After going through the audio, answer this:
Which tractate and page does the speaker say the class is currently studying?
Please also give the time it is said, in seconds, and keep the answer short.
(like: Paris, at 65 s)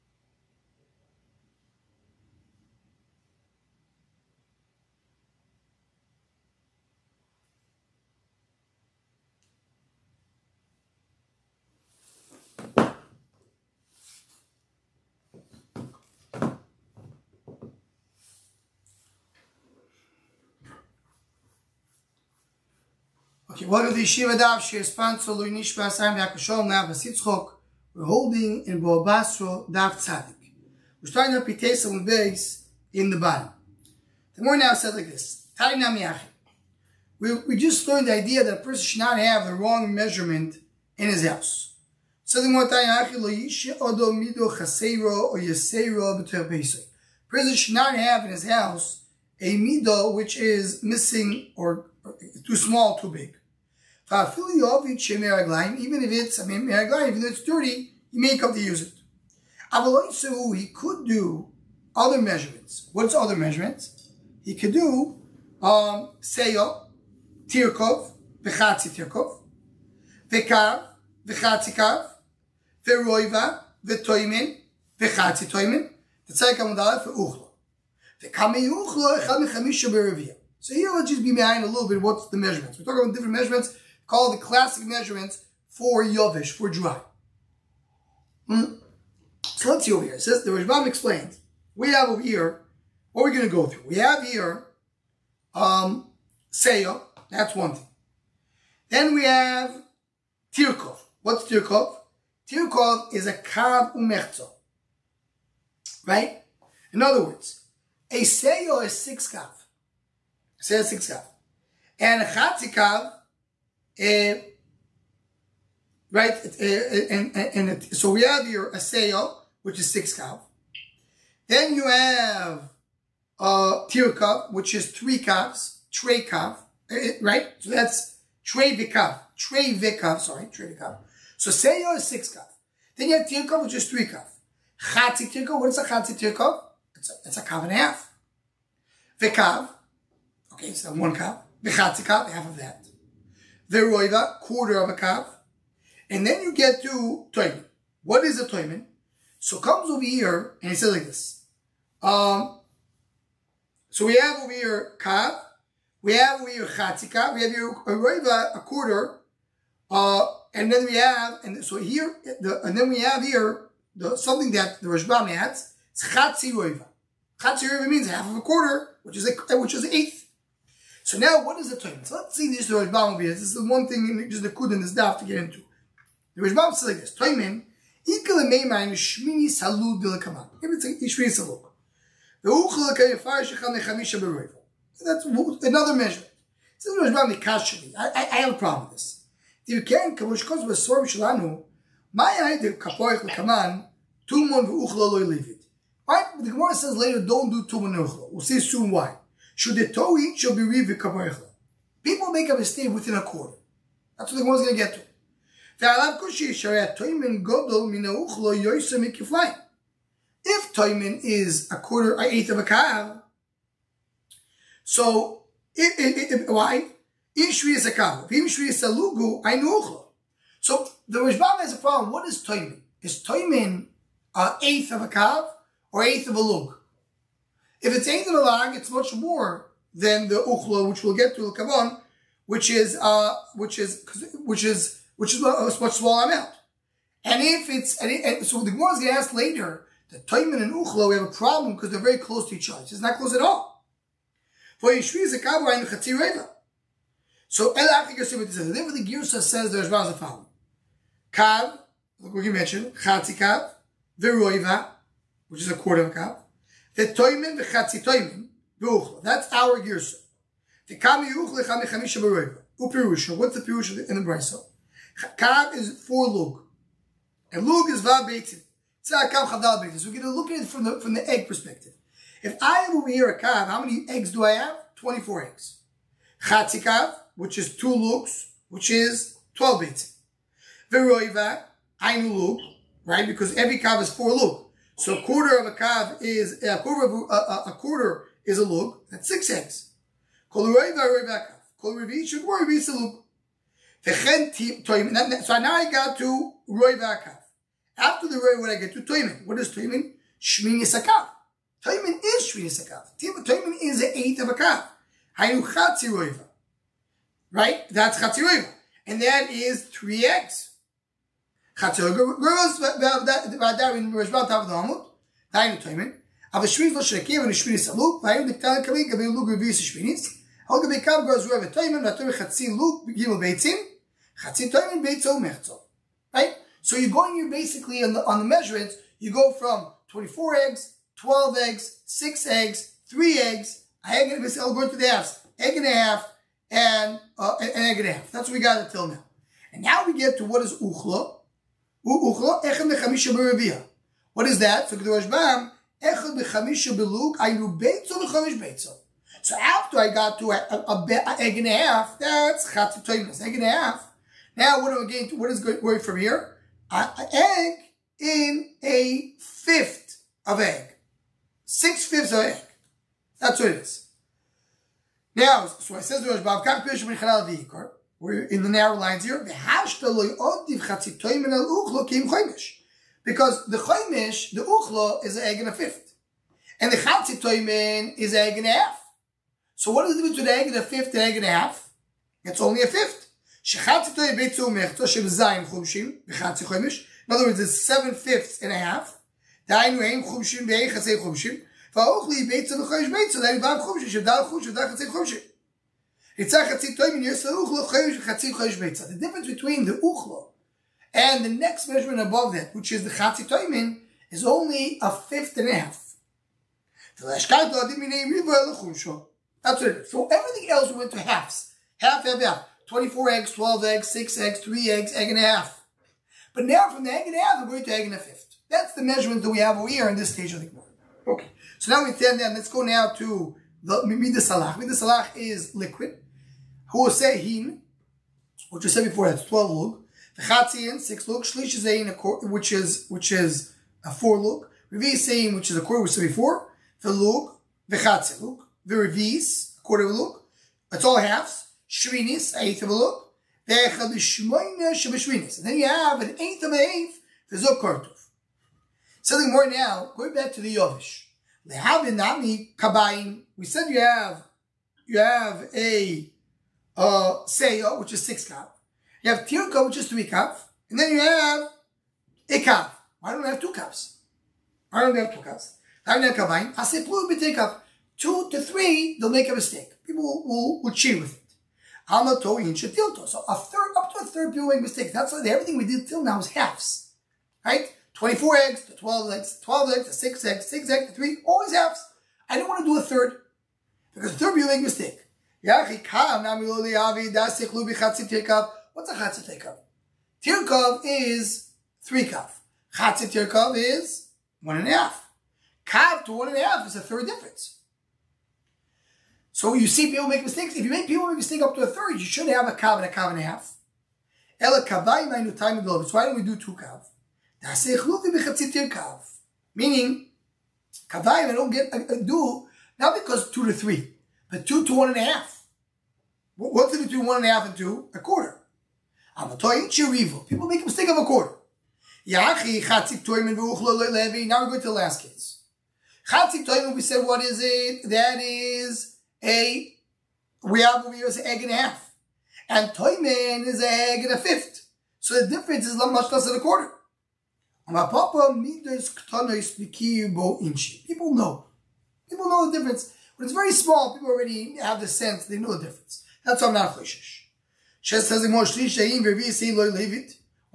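Bava Basra 90, at 28 s.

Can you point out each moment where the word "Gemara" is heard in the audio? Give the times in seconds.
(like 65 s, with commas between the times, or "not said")
196 s, 238 s, 420 s.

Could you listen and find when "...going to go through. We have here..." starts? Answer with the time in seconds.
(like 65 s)
93 s.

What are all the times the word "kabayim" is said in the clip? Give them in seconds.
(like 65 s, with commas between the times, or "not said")
452 s.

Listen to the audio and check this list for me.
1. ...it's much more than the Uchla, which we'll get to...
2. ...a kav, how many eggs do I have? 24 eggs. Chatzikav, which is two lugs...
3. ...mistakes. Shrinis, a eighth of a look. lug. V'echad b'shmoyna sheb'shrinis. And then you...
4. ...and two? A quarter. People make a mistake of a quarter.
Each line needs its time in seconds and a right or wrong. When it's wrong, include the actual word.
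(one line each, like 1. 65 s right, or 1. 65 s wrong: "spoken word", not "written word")
1. 228 s right
2. 273 s right
3. 441 s wrong: "halves", not "mistakes"
4. 517 s right.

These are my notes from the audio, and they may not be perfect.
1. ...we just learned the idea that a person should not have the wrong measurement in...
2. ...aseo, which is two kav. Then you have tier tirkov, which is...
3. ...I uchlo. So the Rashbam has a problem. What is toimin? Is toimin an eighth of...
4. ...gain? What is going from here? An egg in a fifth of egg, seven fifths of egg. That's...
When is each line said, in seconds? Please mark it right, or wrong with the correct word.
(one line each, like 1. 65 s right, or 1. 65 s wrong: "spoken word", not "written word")
1. 37 s right
2. 118 s wrong: "six", not "two"
3. 219 s right
4. 355 s wrong: "six", not "seven".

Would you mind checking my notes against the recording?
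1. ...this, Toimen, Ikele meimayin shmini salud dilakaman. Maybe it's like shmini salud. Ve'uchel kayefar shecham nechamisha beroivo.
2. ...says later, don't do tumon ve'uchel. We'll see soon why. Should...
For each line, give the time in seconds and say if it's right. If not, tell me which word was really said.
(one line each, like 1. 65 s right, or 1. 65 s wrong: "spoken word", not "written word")
1. 176 s right
2. 196 s right.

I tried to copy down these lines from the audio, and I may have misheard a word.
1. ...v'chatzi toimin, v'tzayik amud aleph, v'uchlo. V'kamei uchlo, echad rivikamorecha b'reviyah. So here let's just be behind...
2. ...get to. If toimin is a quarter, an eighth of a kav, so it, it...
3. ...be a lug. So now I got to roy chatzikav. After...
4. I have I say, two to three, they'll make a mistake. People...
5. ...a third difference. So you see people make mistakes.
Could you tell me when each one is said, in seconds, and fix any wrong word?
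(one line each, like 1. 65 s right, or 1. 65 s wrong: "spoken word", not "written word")
1. 74 s wrong: "mechamisha", not "rivikamorecha"
2. 204 s right
3. 292 s wrong: "vakav", not "chatzikav"
4. 466 s right
5. 496 s right.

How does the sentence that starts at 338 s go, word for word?
That's what we got until now.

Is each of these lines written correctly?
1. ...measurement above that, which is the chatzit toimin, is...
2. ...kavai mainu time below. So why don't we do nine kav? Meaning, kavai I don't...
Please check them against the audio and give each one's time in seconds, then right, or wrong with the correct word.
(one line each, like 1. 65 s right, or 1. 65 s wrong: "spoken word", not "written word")
1. 401 s right
2. 504 s wrong: "two", not "nine".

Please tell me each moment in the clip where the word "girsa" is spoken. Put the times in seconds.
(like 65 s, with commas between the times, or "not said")
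249 s, 257 s.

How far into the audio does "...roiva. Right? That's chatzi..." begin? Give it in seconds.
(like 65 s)
306 s.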